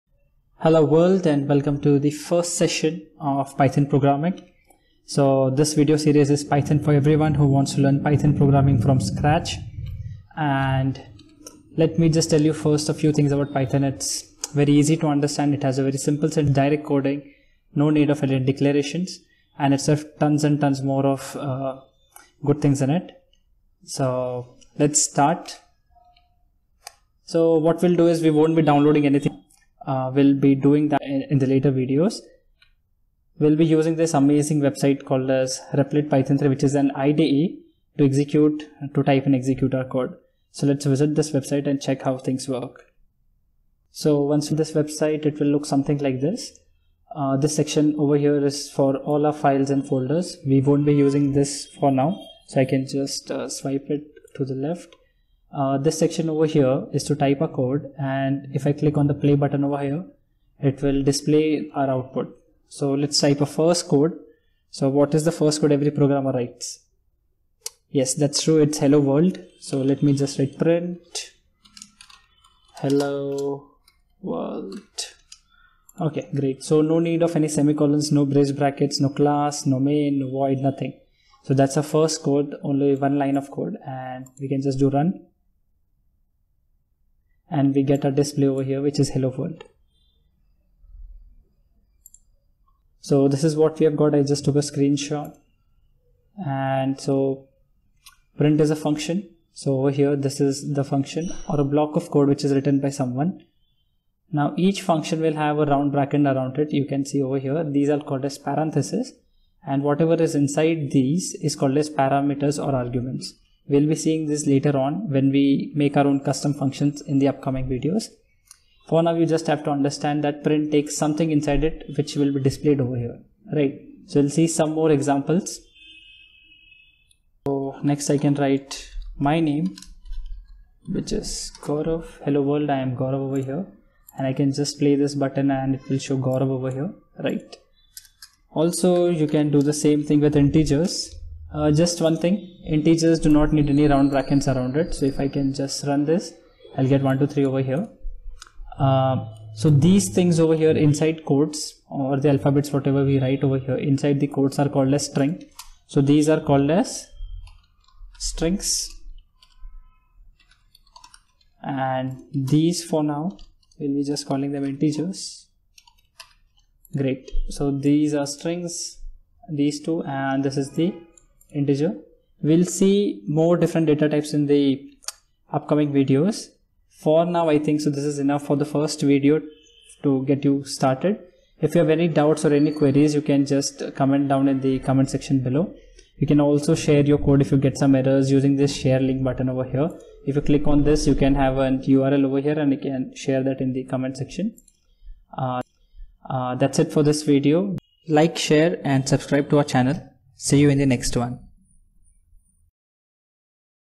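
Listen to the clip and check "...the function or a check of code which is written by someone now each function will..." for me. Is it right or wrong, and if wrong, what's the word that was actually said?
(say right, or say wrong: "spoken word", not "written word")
wrong: "block", not "check".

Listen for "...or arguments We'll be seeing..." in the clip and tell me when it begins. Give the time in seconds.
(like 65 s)
112 s.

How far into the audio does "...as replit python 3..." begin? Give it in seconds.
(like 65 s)
35 s.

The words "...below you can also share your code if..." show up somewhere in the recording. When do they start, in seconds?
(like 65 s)
185 s.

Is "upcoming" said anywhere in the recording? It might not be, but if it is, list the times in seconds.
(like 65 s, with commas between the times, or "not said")
117 s, 175 s.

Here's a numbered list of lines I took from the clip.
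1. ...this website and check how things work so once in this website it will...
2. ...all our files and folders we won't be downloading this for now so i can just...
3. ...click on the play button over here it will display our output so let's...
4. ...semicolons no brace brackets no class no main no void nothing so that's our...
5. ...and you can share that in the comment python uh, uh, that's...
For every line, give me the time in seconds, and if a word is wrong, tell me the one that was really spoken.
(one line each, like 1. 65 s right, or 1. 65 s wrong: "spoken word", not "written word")
1. 41 s right
2. 48 s wrong: "using", not "downloading"
3. 58 s right
4. 77 s right
5. 192 s wrong: "section", not "python".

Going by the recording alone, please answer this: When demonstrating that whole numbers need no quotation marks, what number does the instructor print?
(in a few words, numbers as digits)
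123.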